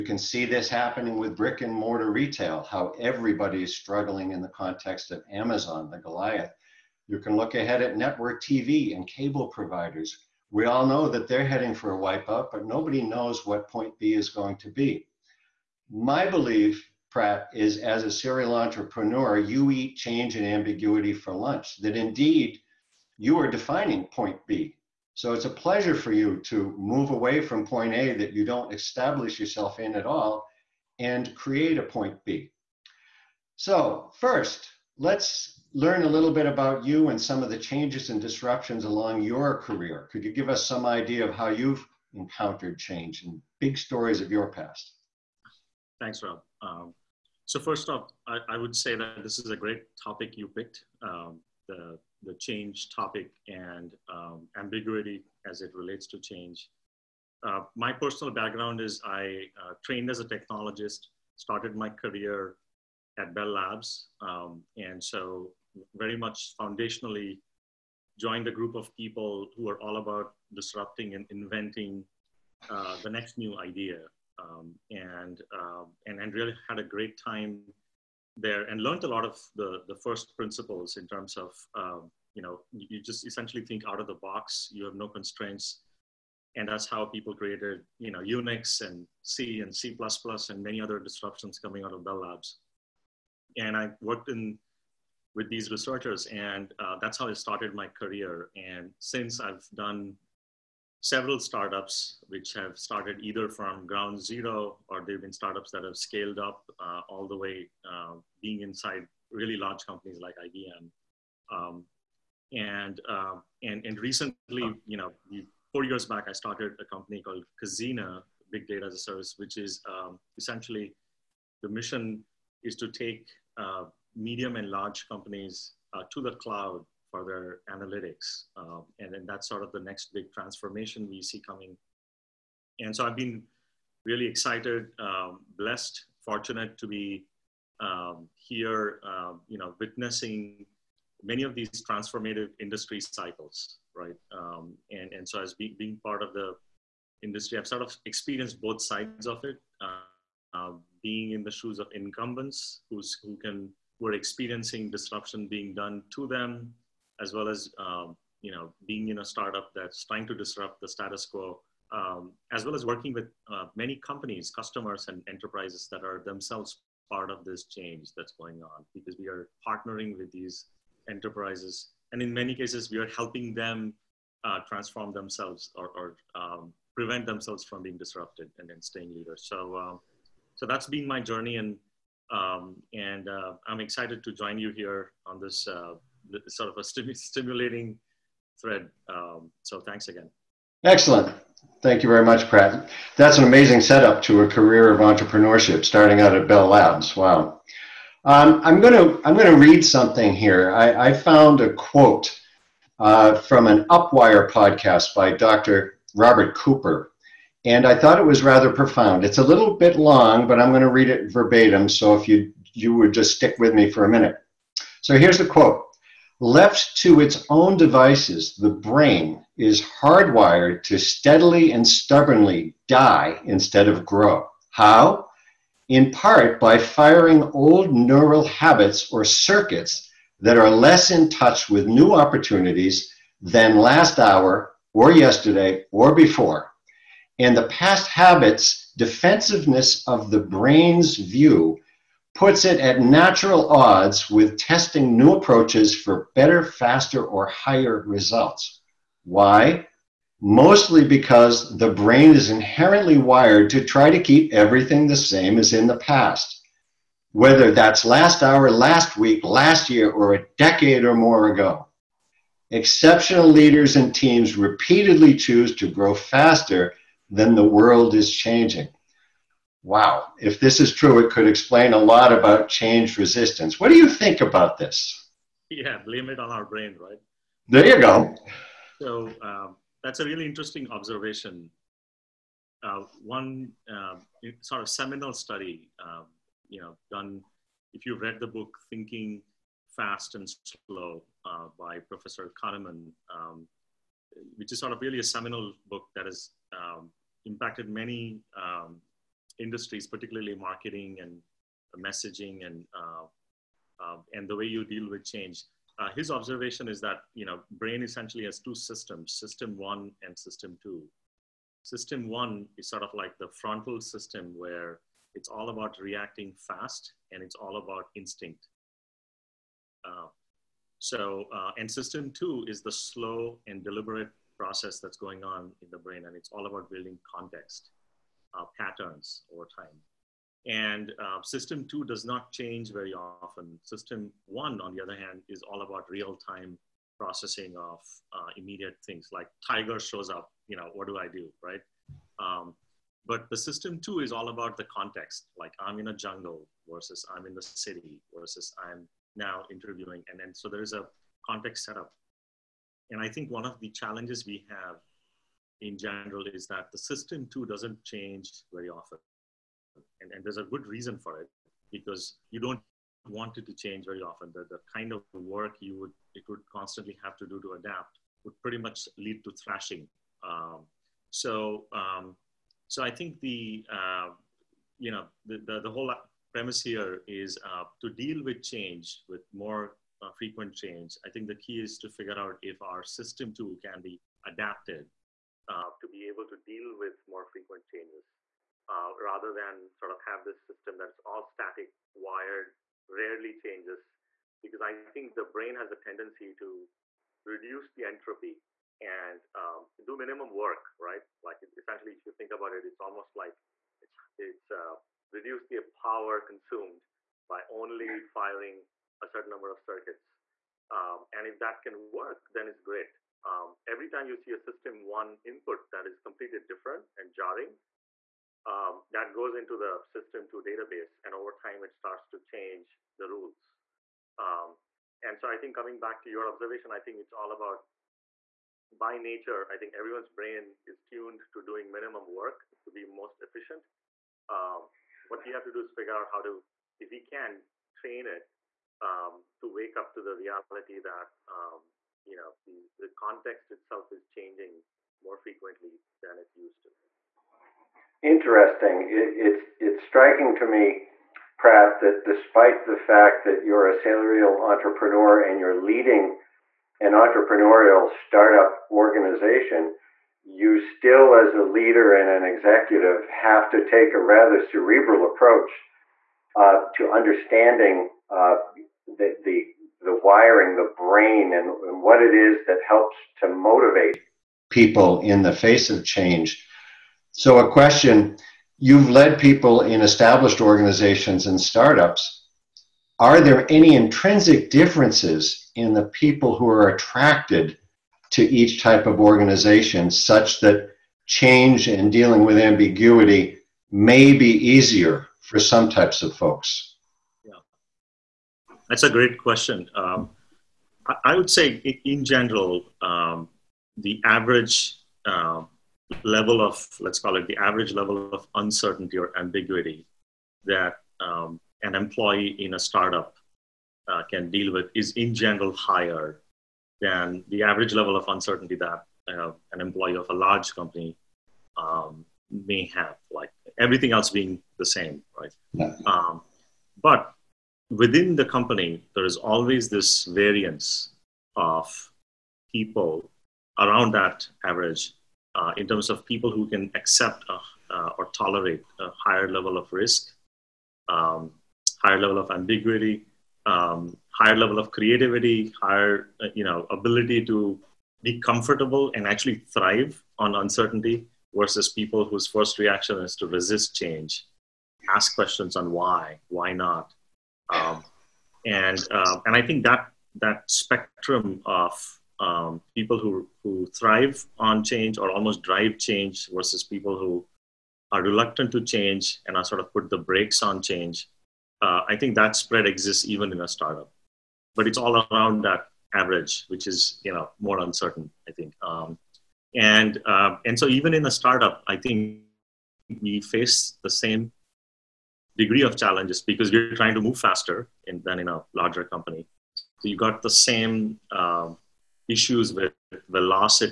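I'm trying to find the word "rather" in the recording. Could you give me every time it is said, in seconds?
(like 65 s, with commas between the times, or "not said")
208 s, 389 s, 464 s.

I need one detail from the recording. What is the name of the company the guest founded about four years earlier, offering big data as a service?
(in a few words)
Cazena.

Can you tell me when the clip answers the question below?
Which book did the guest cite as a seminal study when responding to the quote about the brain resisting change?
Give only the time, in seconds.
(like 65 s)
288 s.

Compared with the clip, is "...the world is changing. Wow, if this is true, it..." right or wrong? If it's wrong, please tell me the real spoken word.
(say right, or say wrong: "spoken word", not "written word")
right.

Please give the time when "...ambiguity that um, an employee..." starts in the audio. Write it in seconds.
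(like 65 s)
509 s.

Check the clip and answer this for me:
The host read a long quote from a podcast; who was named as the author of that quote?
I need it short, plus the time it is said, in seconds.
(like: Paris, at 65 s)
Dr. Robert Cooper, at 205 s.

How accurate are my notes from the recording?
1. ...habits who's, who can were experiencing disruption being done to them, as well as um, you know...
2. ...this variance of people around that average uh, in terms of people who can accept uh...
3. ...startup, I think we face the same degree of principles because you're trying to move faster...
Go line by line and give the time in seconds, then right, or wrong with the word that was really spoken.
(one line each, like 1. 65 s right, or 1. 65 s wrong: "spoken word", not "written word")
1. 151 s wrong: "incumbents", not "habits"
2. 529 s right
3. 581 s wrong: "challenges", not "principles".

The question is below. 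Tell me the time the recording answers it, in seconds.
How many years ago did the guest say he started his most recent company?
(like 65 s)
115 s.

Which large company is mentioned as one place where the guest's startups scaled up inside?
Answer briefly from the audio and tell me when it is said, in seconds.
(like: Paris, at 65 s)
IBM, at 110 s.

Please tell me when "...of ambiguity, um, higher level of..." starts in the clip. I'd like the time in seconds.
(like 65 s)
542 s.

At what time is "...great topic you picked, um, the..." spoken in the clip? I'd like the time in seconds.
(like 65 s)
49 s.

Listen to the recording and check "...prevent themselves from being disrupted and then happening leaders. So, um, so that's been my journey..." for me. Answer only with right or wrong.
wrong.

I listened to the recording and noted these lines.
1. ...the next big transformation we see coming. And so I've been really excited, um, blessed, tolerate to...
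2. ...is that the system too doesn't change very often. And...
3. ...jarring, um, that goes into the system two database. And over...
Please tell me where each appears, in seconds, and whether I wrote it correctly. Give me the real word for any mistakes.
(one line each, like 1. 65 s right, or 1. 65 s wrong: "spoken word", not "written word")
1. 129 s wrong: "fortunate", not "tolerate"
2. 356 s right
3. 417 s right.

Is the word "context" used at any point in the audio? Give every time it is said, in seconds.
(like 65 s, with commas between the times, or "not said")
4 s, 327 s, 344 s, 351 s, 443 s.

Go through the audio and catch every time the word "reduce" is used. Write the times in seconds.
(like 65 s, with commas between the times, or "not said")
397 s, 405 s.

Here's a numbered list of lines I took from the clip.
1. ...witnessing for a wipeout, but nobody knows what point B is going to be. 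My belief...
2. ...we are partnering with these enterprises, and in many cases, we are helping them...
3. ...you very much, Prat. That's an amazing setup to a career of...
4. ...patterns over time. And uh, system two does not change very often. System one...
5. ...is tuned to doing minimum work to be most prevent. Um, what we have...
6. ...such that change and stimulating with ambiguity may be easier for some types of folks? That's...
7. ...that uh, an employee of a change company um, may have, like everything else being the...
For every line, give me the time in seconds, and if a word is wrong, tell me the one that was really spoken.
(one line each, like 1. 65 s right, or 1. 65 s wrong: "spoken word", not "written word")
1. 11 s wrong: "heading", not "witnessing"
2. 169 s right
3. 192 s right
4. 328 s right
5. 430 s wrong: "efficient", not "prevent"
6. 490 s wrong: "dealing", not "stimulating"
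7. 518 s wrong: "large", not "change".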